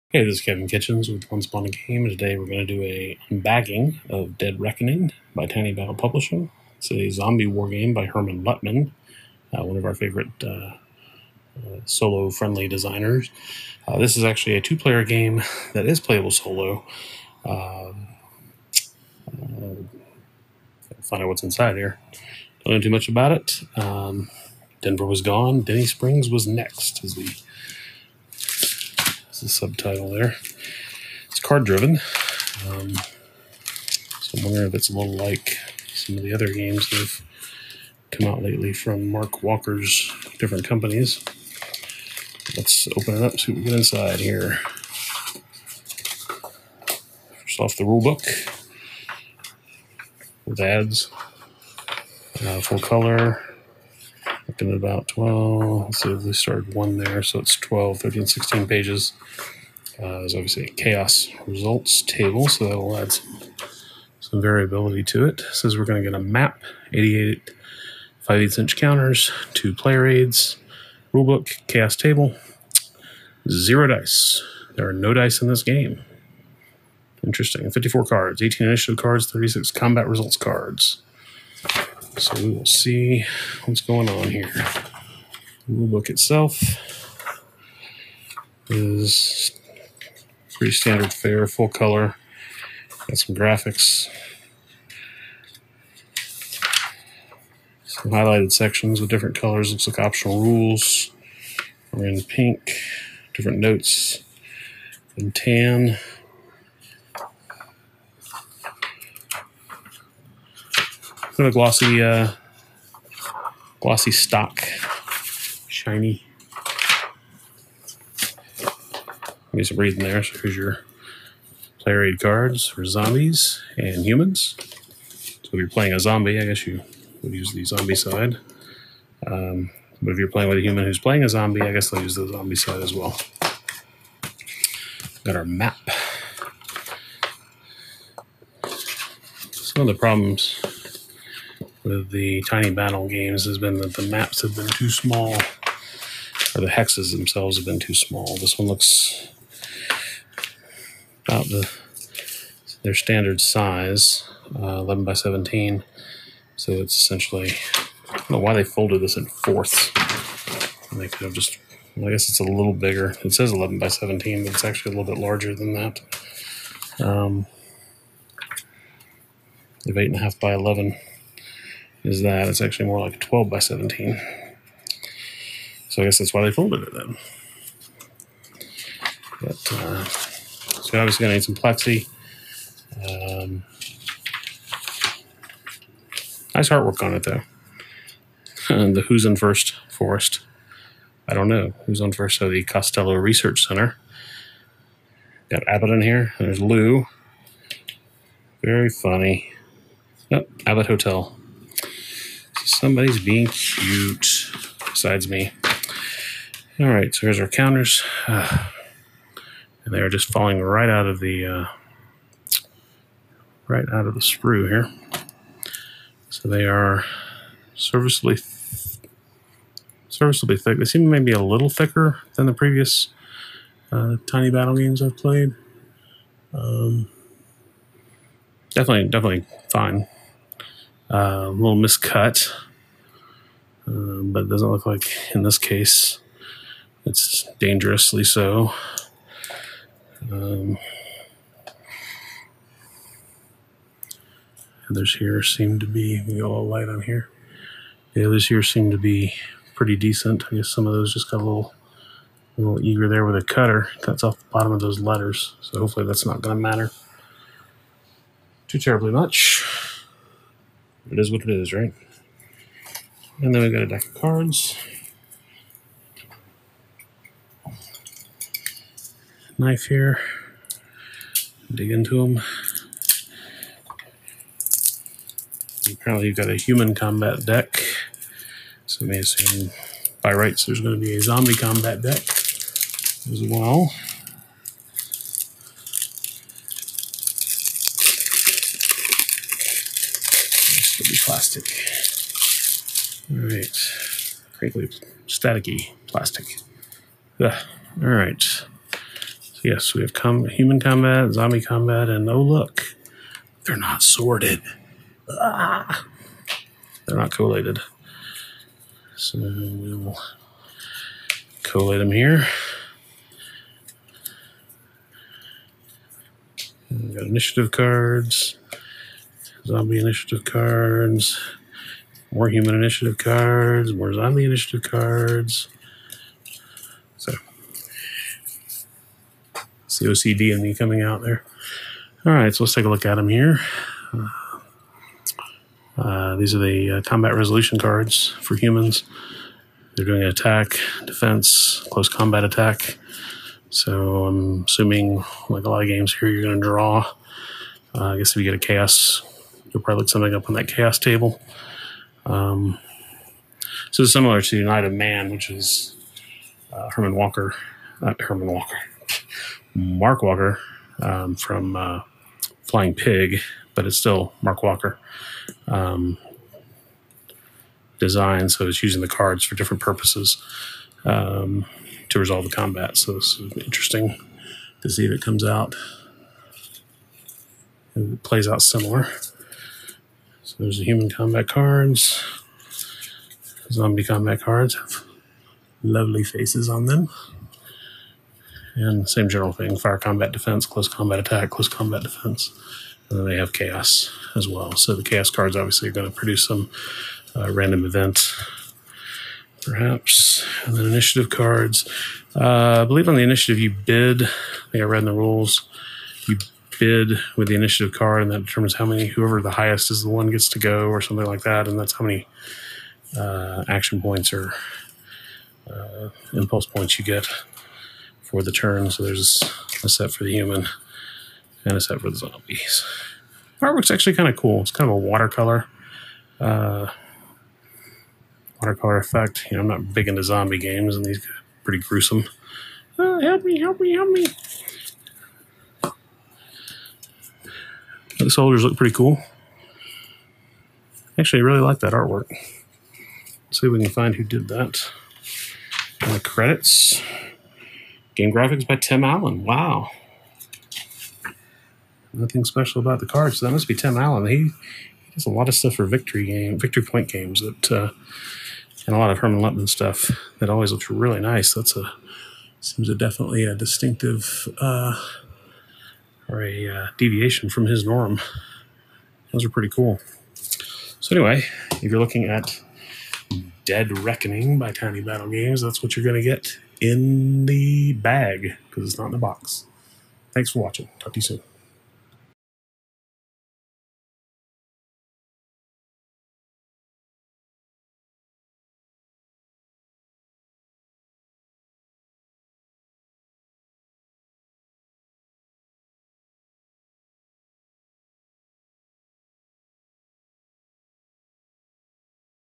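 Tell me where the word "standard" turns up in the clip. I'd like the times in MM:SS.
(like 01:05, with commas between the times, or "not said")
01:30, 02:32.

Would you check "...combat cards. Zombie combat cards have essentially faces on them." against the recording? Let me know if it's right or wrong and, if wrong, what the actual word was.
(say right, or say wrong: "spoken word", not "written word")
wrong: "lovely", not "essentially".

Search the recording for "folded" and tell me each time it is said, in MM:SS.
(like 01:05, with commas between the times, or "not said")
02:38, 02:56.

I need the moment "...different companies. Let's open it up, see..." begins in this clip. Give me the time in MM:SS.
00:40.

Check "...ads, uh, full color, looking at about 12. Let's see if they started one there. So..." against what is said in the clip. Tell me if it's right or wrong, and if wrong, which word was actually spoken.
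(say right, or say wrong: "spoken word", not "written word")
right.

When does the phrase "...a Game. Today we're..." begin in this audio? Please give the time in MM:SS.
00:01.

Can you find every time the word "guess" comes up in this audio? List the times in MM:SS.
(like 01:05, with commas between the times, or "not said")
02:06, 02:11, 02:42, 02:56, 04:10, 05:48.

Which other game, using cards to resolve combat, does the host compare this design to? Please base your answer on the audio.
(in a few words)
Night of Man.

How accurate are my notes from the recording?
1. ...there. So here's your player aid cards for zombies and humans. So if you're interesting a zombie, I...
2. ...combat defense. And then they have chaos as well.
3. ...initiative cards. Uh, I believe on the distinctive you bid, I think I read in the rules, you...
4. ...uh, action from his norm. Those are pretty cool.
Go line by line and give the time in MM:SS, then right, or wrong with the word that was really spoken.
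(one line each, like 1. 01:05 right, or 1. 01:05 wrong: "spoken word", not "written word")
1. 02:00 wrong: "playing", not "interesting"
2. 06:31 right
3. 06:40 wrong: "initiative", not "distinctive"
4. 07:46 wrong: "deviation", not "action".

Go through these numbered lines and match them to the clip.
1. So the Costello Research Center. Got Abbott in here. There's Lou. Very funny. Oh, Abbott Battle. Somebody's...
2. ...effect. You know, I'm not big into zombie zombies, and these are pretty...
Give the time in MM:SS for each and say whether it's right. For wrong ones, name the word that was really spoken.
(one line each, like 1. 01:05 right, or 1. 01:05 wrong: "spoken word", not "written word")
1. 03:12 wrong: "Hotel", not "Battle"
2. 07:08 wrong: "games", not "zombies".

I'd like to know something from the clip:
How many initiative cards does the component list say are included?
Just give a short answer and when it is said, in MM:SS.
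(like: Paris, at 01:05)
18, at 01:18.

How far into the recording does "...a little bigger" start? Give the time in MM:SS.
02:42.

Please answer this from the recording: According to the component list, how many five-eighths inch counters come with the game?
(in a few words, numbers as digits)
88.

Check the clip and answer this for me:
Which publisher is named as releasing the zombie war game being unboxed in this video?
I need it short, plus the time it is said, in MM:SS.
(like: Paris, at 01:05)
Tiny Battle Publishing, at 00:05.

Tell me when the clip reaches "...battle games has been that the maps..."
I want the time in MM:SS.
02:22.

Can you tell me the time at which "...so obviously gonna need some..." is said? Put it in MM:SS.
03:00.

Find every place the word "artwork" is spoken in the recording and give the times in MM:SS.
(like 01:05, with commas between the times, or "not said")
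03:06, 07:03, 07:21.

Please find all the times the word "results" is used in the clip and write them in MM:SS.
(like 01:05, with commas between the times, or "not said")
01:01, 01:20.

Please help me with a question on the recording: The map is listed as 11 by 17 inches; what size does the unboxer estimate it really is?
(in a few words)
12 by 17.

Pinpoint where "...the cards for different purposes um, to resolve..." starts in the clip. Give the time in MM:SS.
06:09.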